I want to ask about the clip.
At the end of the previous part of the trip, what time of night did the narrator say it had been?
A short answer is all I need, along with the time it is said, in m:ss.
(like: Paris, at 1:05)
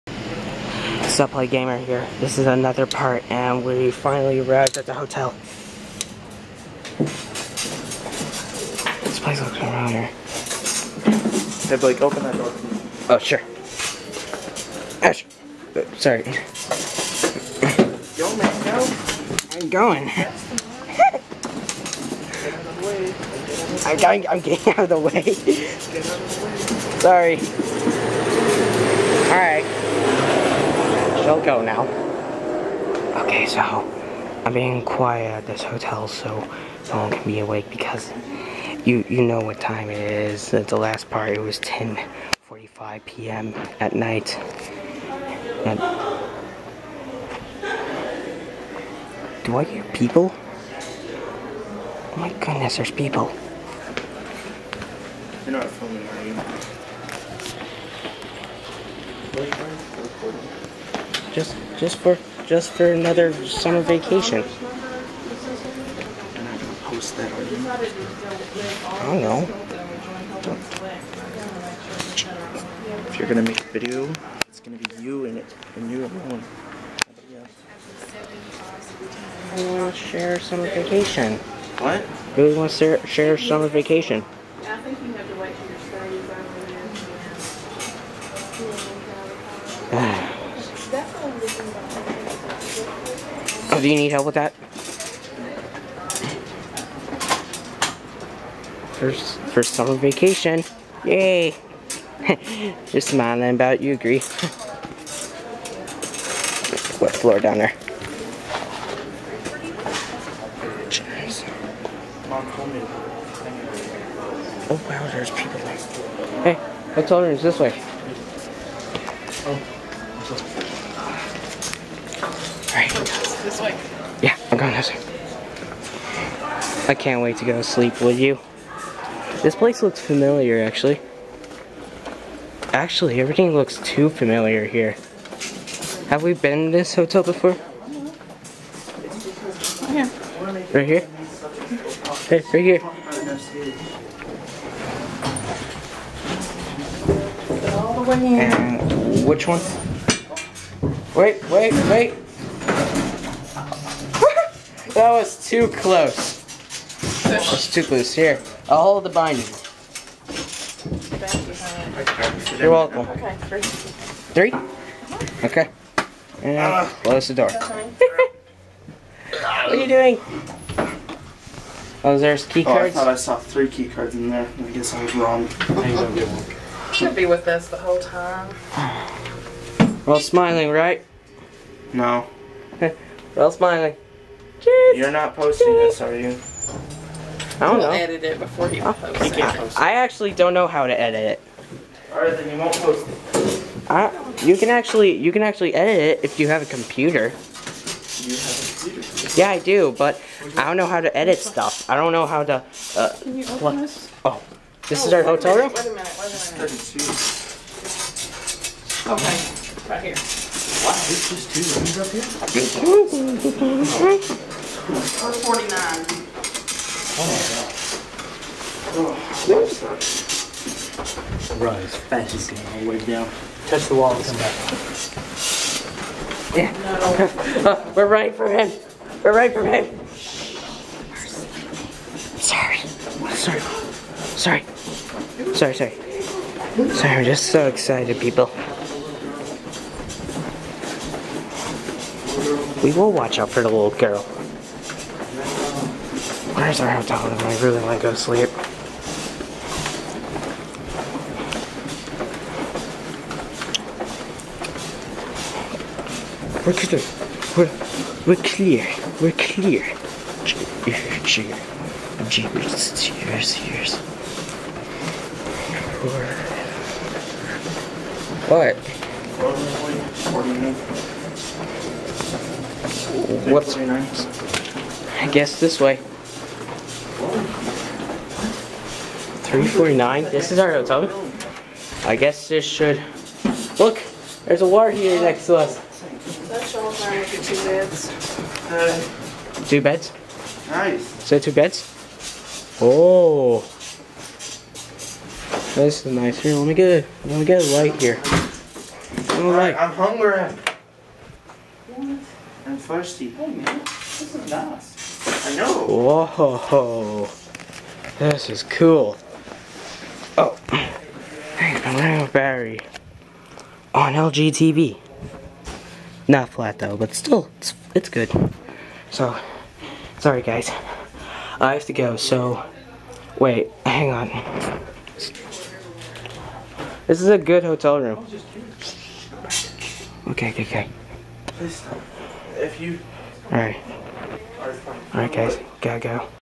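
10:45 p.m., at 0:41.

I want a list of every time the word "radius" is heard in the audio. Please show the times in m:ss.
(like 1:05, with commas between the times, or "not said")
not said.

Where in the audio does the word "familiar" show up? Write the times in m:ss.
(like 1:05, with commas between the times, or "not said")
2:09, 2:14.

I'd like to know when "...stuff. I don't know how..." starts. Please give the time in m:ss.
3:21.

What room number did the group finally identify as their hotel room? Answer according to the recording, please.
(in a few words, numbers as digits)
349.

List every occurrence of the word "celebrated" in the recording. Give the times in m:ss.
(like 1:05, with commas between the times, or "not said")
not said.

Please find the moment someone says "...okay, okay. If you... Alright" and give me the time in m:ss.
5:30.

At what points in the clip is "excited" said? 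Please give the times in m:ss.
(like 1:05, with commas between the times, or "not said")
3:57.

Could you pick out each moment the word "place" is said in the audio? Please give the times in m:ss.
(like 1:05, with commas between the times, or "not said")
0:09, 2:09.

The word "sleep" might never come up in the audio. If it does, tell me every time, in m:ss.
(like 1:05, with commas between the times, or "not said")
2:07, 4:08.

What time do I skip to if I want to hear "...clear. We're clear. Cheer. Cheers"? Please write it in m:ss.
4:18.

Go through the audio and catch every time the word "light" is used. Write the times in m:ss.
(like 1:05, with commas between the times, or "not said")
4:57.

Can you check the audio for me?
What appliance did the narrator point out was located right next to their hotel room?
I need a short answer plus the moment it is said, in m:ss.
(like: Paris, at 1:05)
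water heater, at 4:44.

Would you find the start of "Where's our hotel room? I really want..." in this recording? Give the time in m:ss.
4:06.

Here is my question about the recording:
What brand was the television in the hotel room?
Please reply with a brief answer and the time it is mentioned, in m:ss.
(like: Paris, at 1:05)
LG, at 5:14.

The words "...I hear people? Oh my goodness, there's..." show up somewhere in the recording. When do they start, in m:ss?
0:49.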